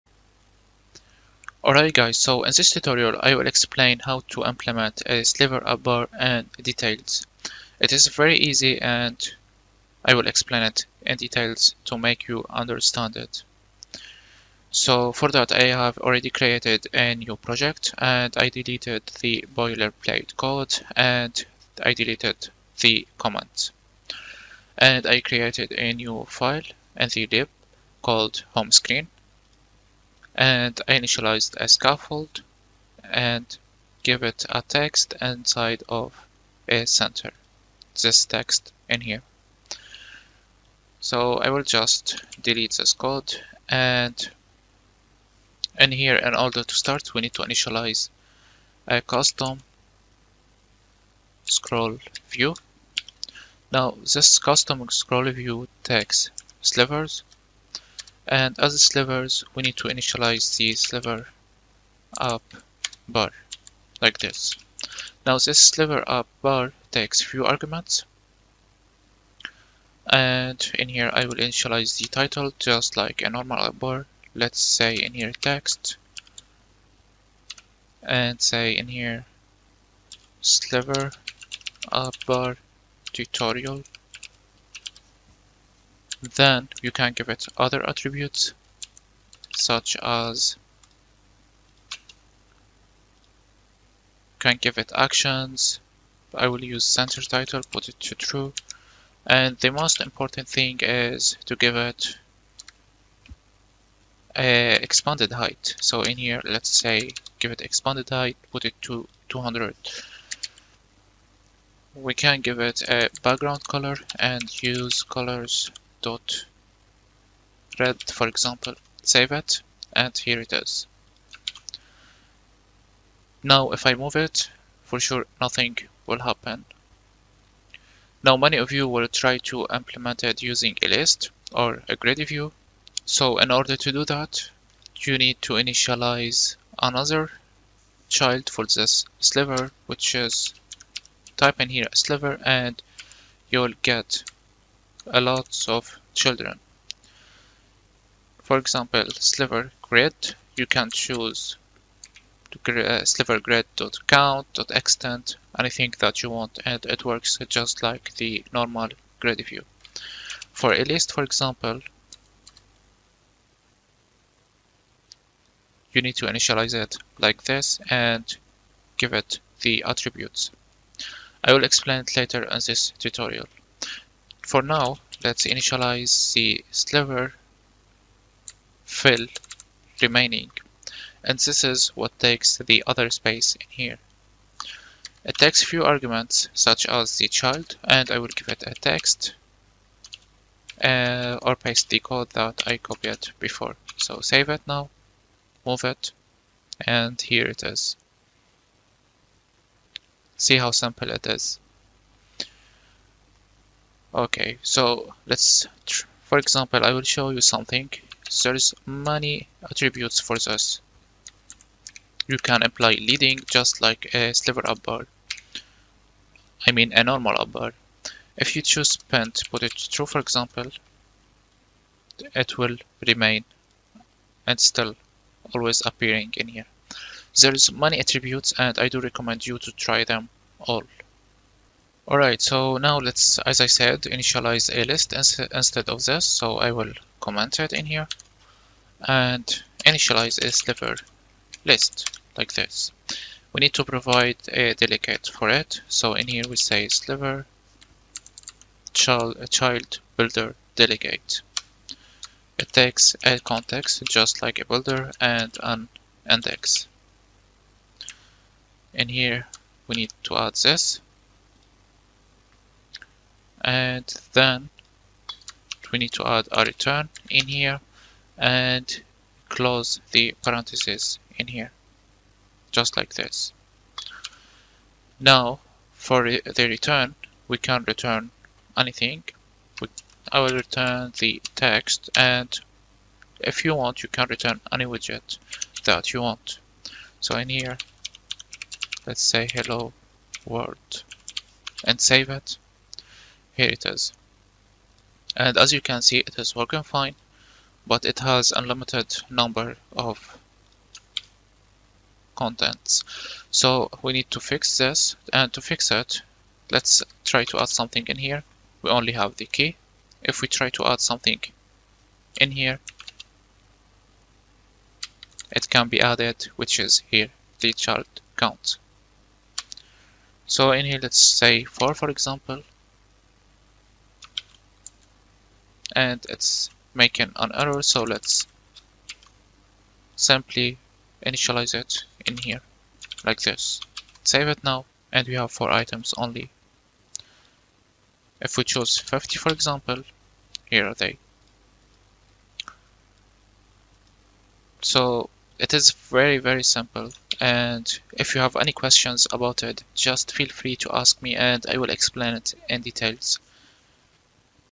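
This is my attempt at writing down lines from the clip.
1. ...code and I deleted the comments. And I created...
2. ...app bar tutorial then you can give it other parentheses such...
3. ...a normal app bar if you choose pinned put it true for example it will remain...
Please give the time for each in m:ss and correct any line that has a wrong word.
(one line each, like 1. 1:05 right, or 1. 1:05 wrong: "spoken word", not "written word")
1. 0:20 right
2. 1:21 wrong: "attributes", not "parentheses"
3. 3:36 right.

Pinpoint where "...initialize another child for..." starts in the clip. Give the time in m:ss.
2:15.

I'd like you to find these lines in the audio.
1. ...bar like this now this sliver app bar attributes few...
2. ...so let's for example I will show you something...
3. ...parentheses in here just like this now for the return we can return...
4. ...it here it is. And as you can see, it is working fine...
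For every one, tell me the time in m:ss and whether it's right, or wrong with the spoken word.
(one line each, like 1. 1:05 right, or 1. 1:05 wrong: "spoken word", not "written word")
1. 1:03 wrong: "takes", not "attributes"
2. 3:24 right
3. 4:30 right
4. 4:52 right.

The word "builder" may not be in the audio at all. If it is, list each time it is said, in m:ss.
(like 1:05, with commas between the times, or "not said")
4:10, 4:14.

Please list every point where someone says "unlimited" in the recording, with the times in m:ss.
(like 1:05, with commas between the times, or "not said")
4:58.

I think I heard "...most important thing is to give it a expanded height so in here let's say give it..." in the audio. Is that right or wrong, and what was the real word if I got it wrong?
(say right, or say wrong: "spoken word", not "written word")
right.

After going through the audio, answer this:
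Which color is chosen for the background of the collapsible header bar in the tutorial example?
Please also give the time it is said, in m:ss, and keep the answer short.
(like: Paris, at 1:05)
red, at 1:55.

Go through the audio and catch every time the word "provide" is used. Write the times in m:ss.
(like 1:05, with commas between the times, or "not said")
4:03.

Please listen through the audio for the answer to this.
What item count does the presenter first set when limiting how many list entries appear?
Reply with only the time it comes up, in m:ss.
5:21.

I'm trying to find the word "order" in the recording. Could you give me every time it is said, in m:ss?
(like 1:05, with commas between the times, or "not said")
0:46, 2:13.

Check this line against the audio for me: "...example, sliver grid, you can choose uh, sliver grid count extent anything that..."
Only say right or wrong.
right.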